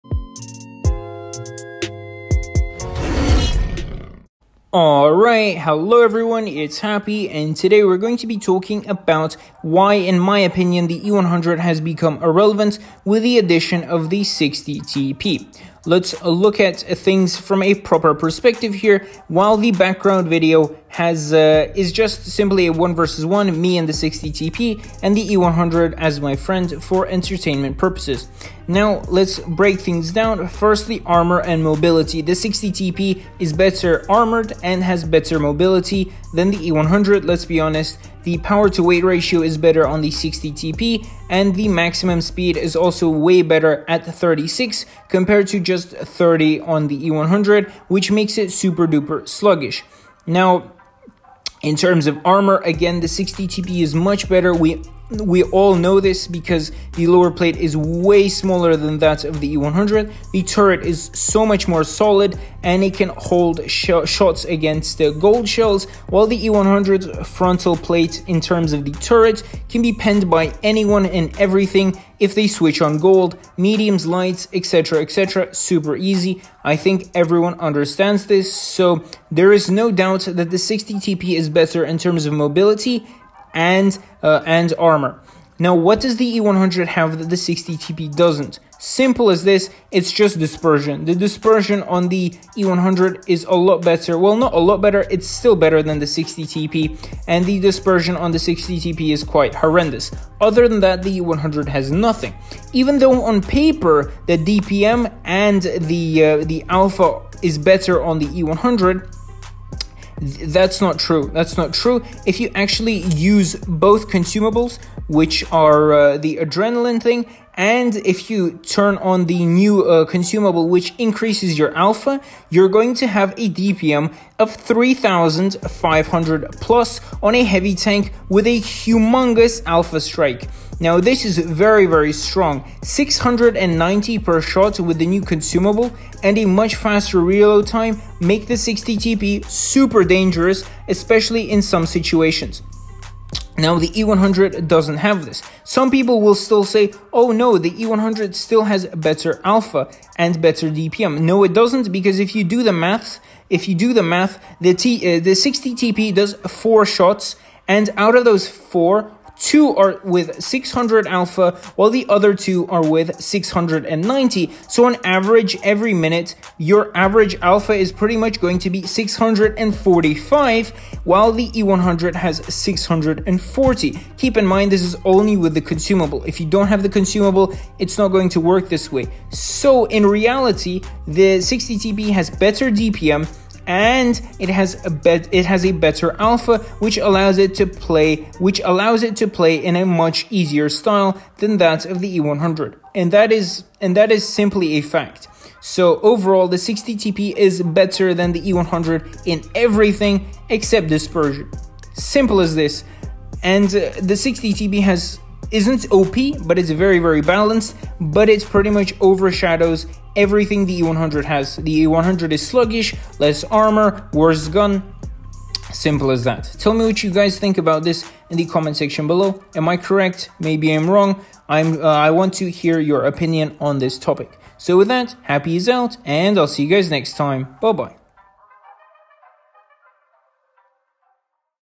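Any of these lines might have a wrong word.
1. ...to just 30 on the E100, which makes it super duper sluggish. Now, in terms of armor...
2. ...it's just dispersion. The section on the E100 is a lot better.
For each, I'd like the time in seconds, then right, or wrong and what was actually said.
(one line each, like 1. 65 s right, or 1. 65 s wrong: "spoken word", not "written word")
1. 45 s right
2. 89 s wrong: "dispersion", not "section".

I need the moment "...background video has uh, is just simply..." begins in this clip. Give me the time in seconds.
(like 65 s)
19 s.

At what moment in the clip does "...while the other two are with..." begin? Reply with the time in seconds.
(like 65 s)
161 s.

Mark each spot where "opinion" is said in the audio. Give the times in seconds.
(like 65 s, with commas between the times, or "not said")
10 s, 223 s.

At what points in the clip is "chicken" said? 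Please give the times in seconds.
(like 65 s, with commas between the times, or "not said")
not said.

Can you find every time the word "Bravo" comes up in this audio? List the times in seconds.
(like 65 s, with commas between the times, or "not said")
not said.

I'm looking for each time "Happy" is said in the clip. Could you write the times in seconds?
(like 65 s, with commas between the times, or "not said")
6 s, 225 s.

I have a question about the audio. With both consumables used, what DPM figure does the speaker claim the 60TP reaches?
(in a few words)
3,500.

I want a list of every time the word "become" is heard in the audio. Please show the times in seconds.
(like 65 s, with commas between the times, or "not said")
11 s.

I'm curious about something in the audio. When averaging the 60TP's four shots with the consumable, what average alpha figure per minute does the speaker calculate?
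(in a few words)
645.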